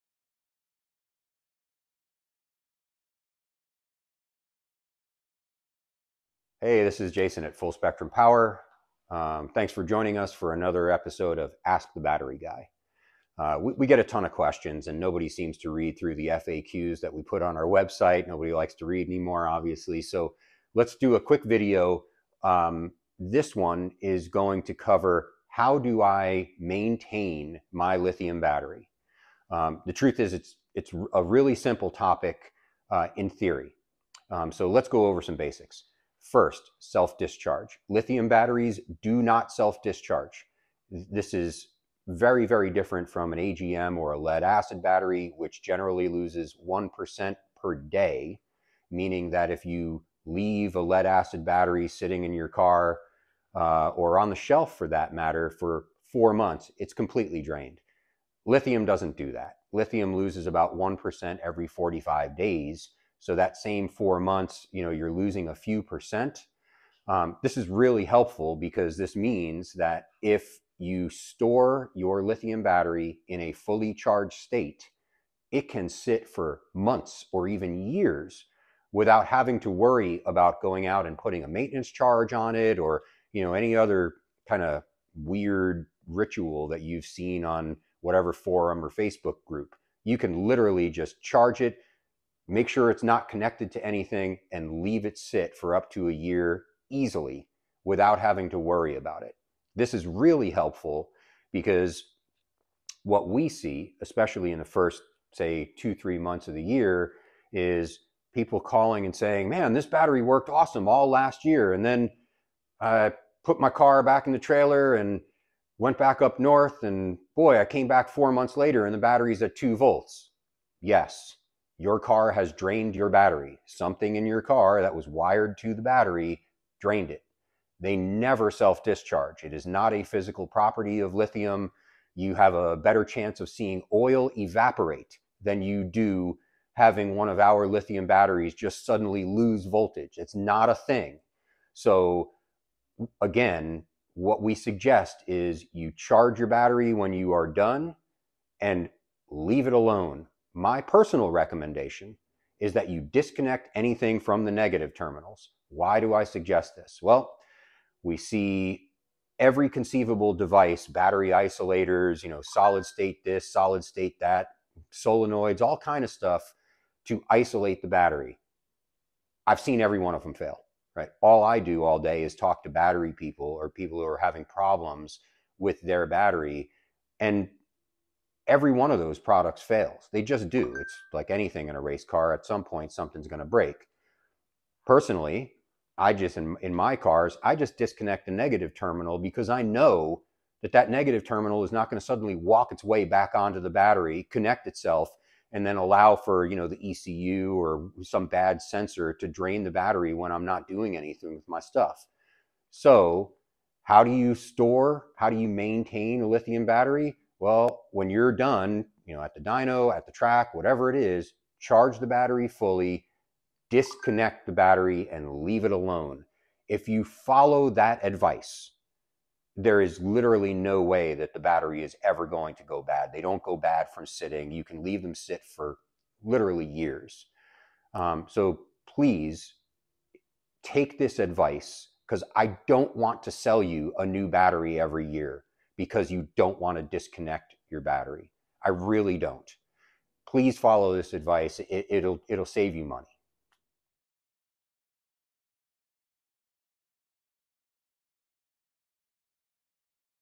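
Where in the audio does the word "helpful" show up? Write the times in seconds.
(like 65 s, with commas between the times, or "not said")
68 s, 100 s.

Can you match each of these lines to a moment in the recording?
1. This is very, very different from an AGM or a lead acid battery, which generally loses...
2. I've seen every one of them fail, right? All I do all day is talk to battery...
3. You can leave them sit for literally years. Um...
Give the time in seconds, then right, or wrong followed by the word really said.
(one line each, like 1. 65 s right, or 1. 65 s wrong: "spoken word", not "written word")
1. 41 s right
2. 169 s right
3. 224 s right.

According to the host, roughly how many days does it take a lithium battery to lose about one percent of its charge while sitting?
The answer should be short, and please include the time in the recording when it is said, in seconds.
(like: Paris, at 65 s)
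45 days, at 61 s.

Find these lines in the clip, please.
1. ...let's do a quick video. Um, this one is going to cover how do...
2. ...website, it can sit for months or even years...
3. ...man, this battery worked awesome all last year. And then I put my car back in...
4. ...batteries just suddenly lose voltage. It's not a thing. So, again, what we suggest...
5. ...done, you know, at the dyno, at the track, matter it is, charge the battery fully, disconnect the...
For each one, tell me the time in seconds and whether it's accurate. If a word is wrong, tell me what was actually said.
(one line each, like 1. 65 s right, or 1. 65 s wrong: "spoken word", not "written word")
1. 20 s right
2. 74 s wrong: "state", not "website"
3. 109 s right
4. 138 s right
5. 208 s wrong: "whatever", not "matter".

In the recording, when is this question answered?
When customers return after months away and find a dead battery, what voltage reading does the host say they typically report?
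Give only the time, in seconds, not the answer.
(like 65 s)
119 s.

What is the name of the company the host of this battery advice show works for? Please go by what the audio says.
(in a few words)
Full Spectrum Power.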